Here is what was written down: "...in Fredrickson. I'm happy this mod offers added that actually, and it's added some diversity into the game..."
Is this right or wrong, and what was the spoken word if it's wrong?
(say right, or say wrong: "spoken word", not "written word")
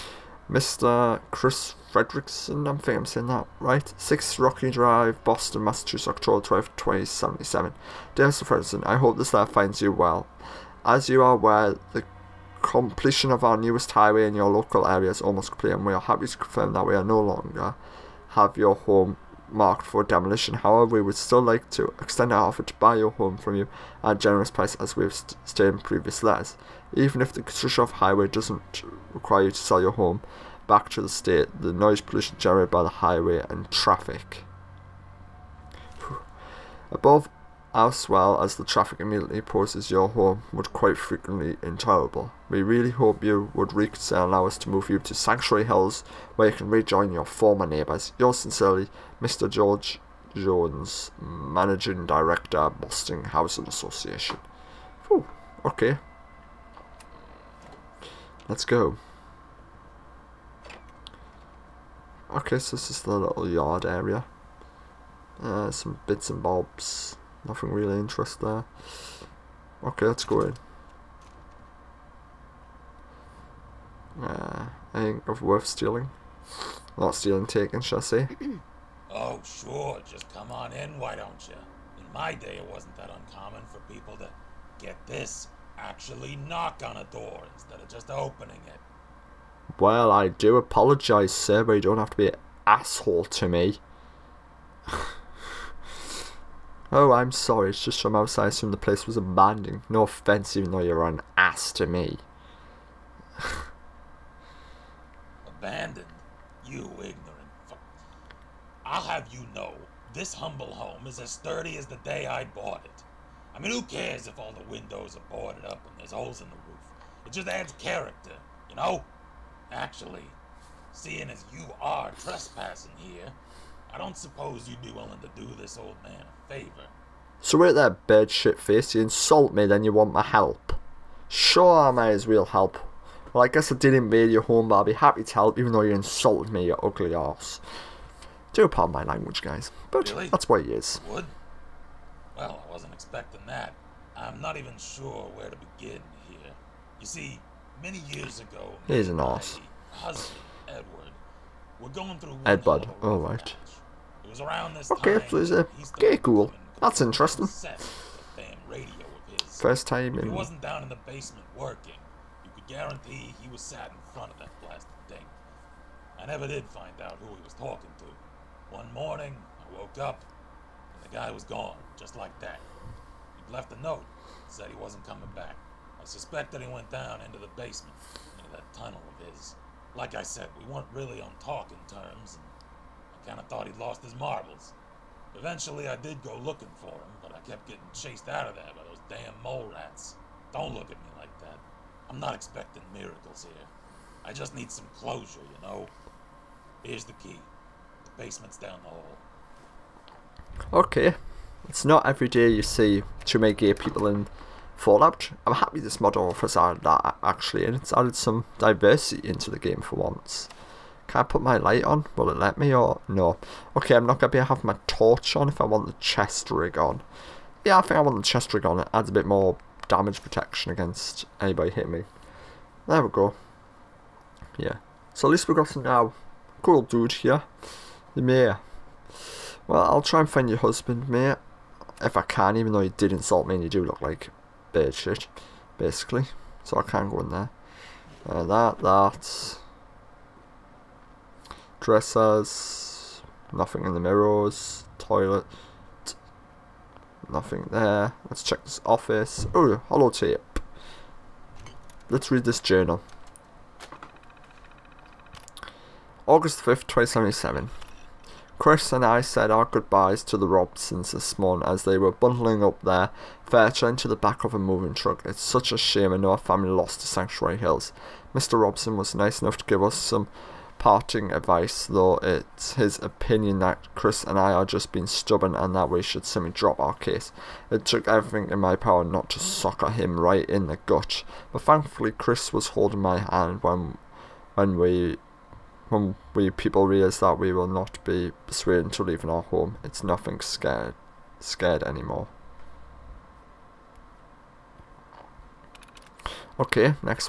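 wrong: "Fallout", not "Fredrickson".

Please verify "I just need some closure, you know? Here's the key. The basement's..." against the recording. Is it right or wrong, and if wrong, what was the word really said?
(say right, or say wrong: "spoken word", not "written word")
right.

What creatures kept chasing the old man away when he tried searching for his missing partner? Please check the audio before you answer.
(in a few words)
mole rats.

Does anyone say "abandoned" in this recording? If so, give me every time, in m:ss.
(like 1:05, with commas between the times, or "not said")
1:39, 1:45.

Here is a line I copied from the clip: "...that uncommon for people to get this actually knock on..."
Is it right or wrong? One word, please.
right.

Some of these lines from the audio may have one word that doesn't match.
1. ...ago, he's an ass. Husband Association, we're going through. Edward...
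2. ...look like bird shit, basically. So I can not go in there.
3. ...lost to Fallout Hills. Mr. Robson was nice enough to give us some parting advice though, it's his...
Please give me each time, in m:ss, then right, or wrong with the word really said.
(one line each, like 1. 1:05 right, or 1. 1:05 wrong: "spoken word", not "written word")
1. 2:28 wrong: "Edward", not "Association"
2. 3:53 right
3. 4:26 wrong: "Sanctuary", not "Fallout".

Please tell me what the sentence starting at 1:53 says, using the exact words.
I mean, who cares if all the windows are boarded up and there's holes in the roof?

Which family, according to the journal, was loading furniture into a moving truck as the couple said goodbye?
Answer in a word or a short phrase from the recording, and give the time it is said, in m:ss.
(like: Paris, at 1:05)
the Robsons, at 4:20.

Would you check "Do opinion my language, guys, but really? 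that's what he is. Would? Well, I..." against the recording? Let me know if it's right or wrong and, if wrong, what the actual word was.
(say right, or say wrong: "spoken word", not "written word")
wrong: "pardon", not "opinion".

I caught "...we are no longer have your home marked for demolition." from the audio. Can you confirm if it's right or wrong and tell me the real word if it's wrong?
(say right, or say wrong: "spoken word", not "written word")
right.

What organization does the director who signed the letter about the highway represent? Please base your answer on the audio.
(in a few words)
Boston Housing Association.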